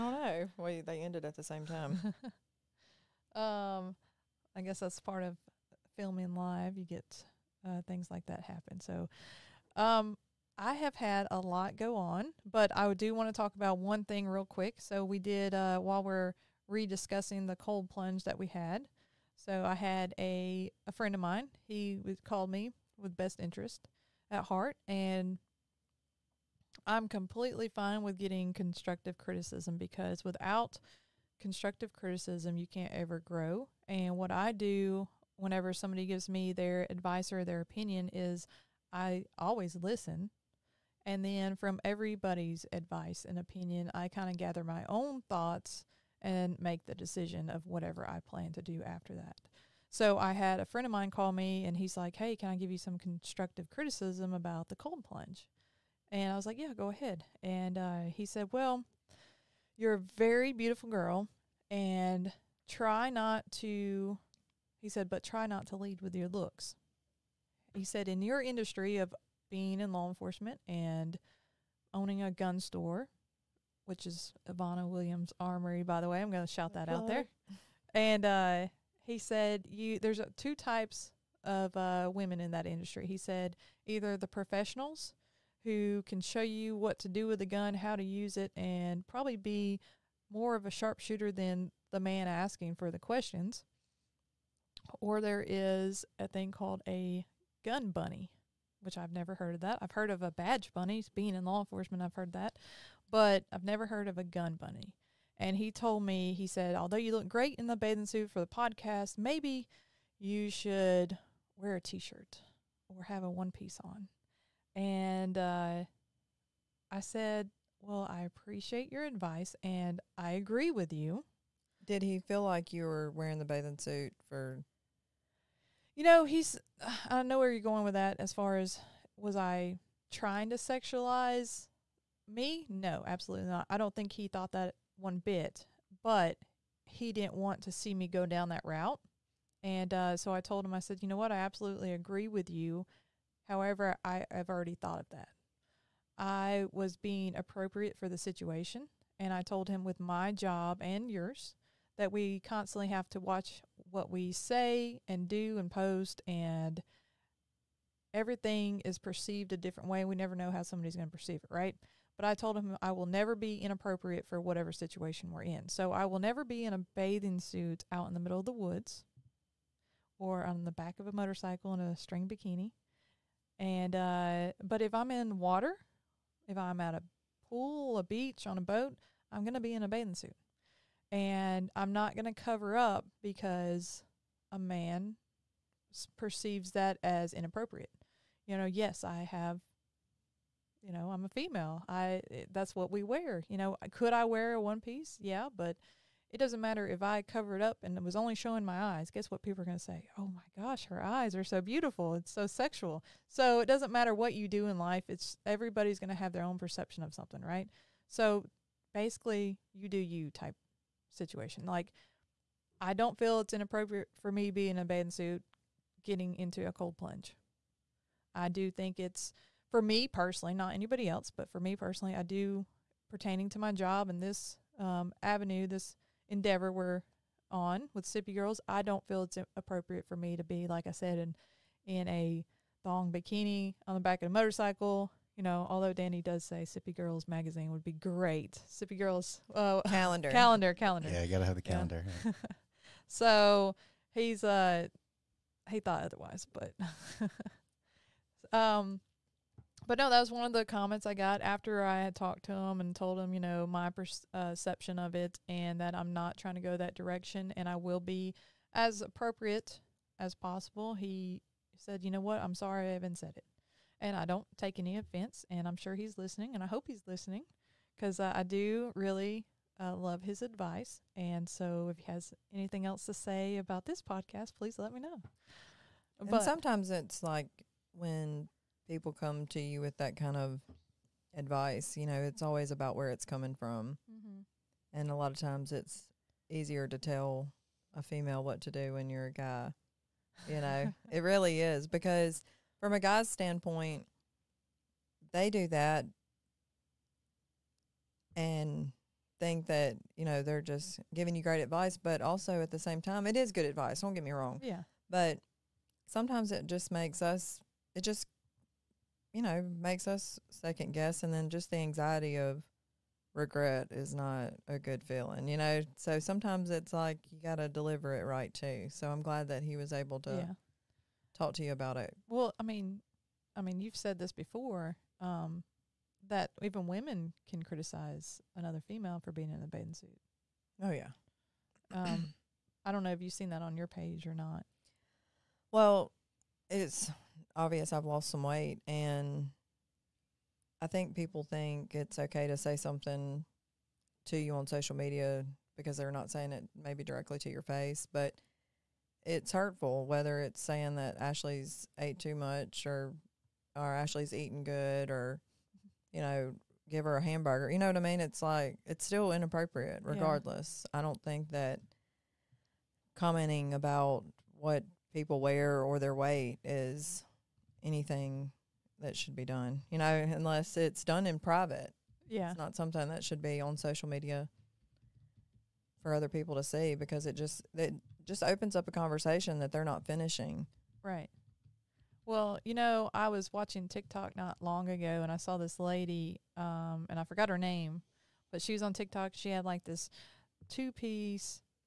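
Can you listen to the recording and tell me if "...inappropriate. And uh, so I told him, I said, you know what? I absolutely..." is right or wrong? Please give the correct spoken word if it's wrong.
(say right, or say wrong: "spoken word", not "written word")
wrong: "route", not "inappropriate".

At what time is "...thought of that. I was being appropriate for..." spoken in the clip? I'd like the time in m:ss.
2:24.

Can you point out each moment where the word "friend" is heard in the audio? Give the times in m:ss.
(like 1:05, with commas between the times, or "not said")
0:20, 0:50.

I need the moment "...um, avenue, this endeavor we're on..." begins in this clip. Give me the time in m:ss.
3:44.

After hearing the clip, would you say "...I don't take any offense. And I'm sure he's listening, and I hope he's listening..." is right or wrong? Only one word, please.
right.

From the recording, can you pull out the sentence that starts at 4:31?
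And so, if he has anything else to say about this podcast, please let me know.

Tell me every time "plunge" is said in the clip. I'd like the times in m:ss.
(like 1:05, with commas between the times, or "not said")
0:17, 0:55, 3:36.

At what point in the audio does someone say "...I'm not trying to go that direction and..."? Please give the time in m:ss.
4:15.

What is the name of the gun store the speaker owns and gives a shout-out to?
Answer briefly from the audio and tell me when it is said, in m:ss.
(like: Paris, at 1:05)
Ivana Williams Armory, at 1:14.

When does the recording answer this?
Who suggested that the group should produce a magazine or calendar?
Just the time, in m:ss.
3:55.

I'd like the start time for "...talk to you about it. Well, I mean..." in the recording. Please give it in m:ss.
5:21.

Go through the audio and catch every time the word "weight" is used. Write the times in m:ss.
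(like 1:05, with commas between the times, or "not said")
5:38, 6:06.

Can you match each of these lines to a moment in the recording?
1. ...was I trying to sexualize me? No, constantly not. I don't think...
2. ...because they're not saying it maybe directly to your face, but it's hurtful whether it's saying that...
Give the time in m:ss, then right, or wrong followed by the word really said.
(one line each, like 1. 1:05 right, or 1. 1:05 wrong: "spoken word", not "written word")
1. 2:09 wrong: "absolutely", not "constantly"
2. 5:45 right.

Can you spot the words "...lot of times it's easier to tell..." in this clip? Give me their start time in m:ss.
4:45.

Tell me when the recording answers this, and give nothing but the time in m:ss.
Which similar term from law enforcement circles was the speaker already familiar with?
1:40.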